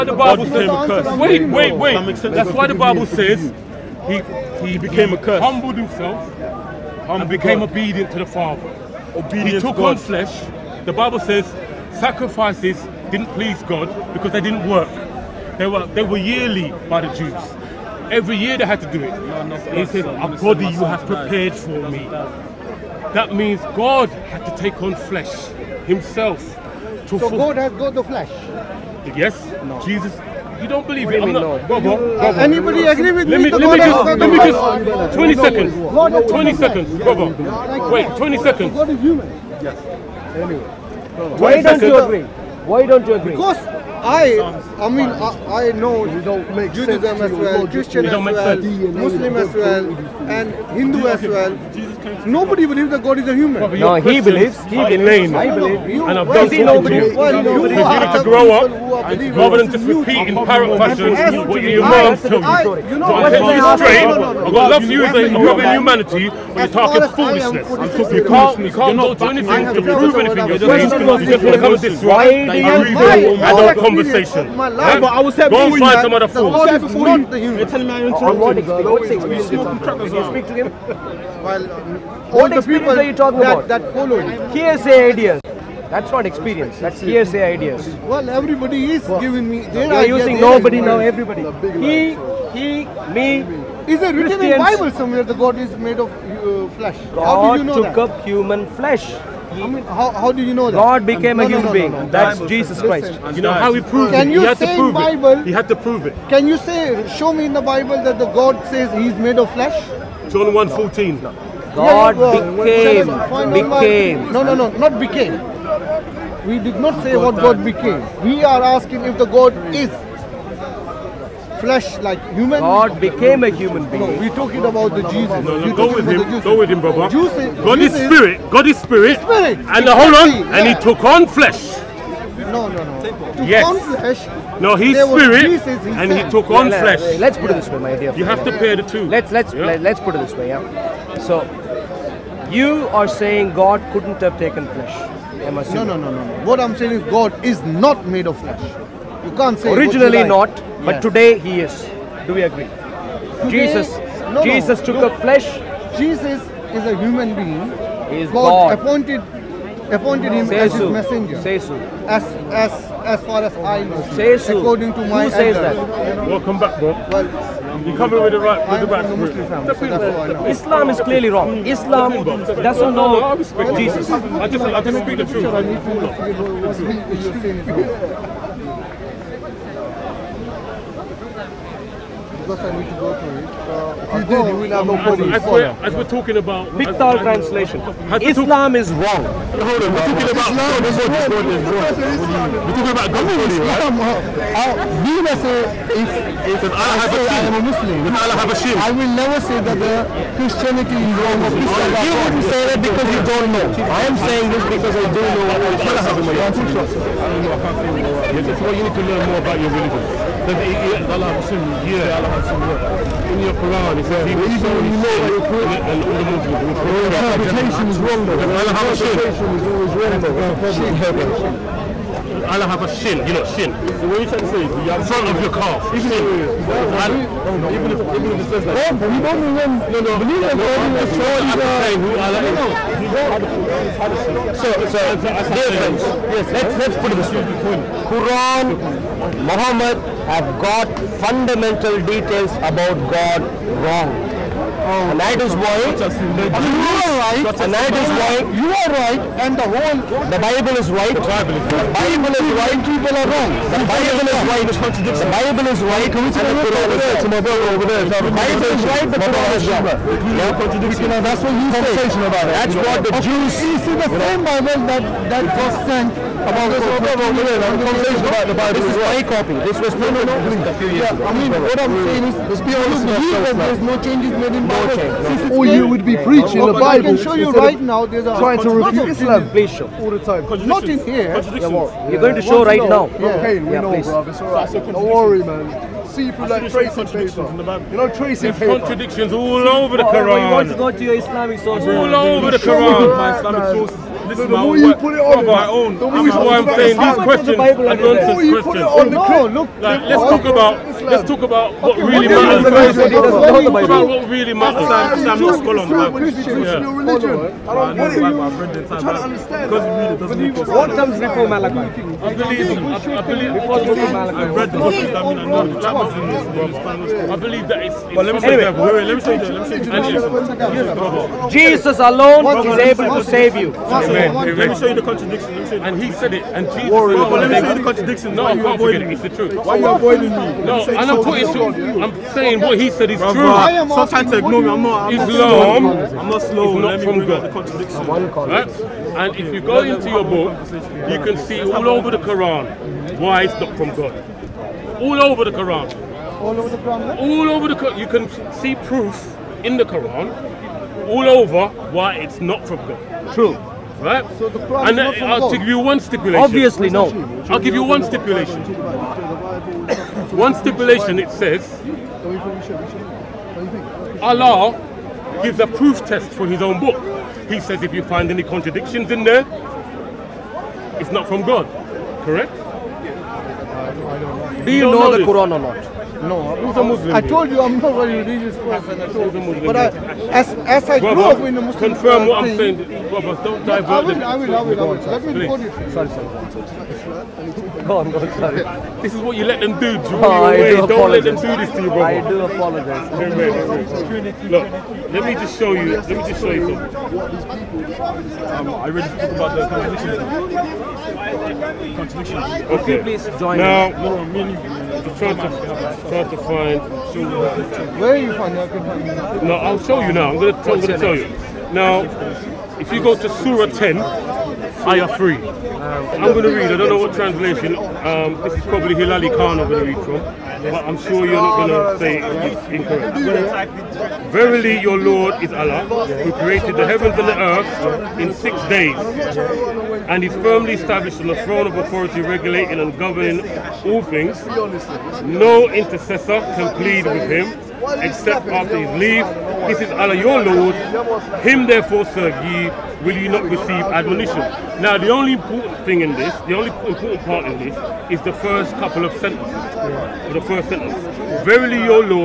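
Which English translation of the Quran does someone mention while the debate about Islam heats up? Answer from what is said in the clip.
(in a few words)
Pickthall.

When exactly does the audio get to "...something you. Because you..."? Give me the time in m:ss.
0:56.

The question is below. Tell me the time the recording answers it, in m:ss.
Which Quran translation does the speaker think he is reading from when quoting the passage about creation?
6:58.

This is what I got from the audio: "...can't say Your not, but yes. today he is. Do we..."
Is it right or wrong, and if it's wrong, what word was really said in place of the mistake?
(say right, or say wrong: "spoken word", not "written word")
wrong: "Originally", not "Your".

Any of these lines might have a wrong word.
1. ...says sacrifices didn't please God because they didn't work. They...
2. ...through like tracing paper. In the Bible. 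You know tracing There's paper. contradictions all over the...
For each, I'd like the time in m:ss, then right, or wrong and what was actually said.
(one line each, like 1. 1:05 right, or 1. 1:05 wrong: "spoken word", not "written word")
1. 0:11 right
2. 4:46 right.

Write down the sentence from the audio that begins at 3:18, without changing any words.
I will never say that the Christianity is wrong or Christians are You wouldn't say that because you don't know.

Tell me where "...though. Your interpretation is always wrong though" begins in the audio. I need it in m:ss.
3:38.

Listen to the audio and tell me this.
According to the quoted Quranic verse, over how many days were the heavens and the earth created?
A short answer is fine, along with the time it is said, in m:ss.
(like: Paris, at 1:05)
6, at 7:08.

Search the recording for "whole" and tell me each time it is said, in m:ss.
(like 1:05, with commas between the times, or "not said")
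2:09, 4:09.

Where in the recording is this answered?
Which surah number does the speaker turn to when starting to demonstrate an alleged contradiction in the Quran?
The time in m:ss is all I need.
6:53.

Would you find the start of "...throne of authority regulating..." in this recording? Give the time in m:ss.
7:11.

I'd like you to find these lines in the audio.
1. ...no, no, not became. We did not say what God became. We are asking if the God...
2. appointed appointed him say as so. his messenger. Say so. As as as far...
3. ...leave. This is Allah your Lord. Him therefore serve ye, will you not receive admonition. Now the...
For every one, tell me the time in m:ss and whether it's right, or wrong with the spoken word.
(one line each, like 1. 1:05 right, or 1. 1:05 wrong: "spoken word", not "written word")
1. 1:54 right
2. 2:38 right
3. 7:18 right.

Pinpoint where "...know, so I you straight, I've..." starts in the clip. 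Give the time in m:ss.
1:02.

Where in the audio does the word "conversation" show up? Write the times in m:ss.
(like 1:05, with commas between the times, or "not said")
1:13, 4:27.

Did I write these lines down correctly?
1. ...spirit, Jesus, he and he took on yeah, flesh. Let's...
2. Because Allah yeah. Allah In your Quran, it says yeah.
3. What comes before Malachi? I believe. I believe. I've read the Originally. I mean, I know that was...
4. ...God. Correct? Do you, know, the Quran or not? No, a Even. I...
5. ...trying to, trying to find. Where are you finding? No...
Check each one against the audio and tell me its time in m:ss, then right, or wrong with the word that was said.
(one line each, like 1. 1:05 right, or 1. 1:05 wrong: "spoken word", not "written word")
1. 2:14 right
2. 3:30 right
3. 5:10 wrong: "Gospels", not "Originally"
4. 6:11 wrong: "Muslim", not "Even"
5. 6:45 right.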